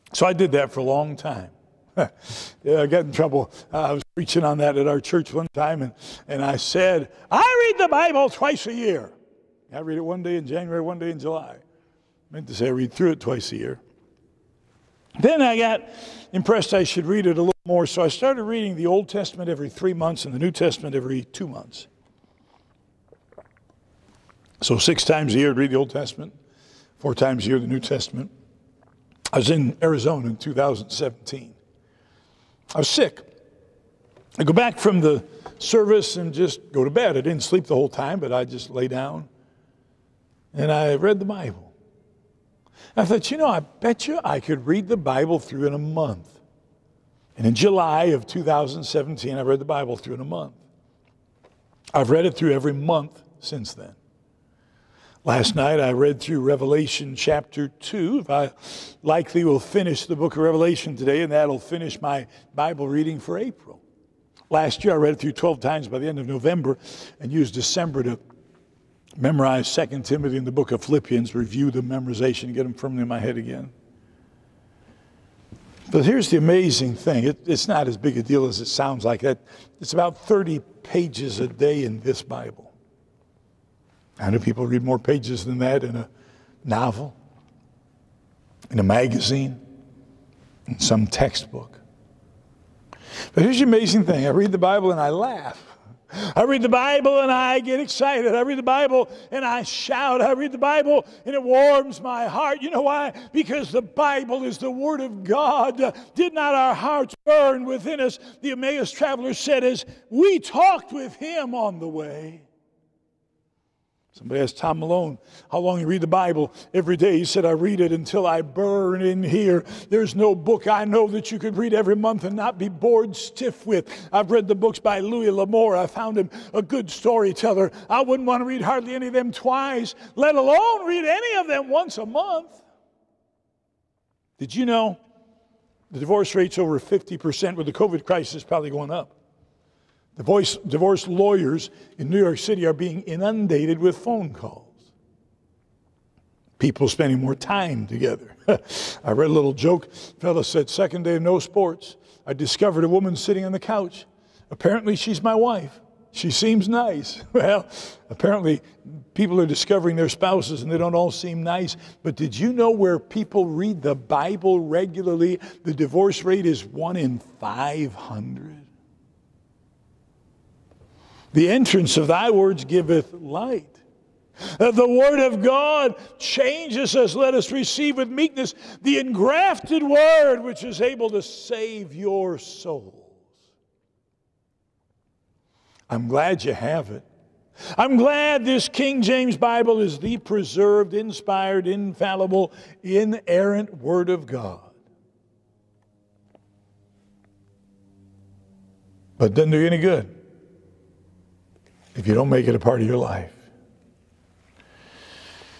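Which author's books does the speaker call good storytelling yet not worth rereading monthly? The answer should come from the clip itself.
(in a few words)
Louis L'Amour.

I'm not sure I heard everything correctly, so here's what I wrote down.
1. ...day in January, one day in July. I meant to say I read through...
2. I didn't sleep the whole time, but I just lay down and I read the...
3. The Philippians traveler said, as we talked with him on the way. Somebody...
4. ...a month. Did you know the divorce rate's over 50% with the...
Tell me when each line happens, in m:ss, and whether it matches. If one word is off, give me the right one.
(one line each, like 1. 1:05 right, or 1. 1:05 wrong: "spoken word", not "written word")
1. 0:10 right
2. 0:37 right
3. 1:48 wrong: "Emmaus", not "Philippians"
4. 2:11 right.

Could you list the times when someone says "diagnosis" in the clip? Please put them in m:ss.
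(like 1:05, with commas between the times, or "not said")
not said.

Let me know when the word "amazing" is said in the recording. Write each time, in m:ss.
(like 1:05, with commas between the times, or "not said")
1:16, 1:33.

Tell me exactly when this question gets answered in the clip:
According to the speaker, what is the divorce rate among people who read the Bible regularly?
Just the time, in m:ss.
2:46.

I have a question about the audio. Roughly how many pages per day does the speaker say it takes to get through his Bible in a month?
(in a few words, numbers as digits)
30.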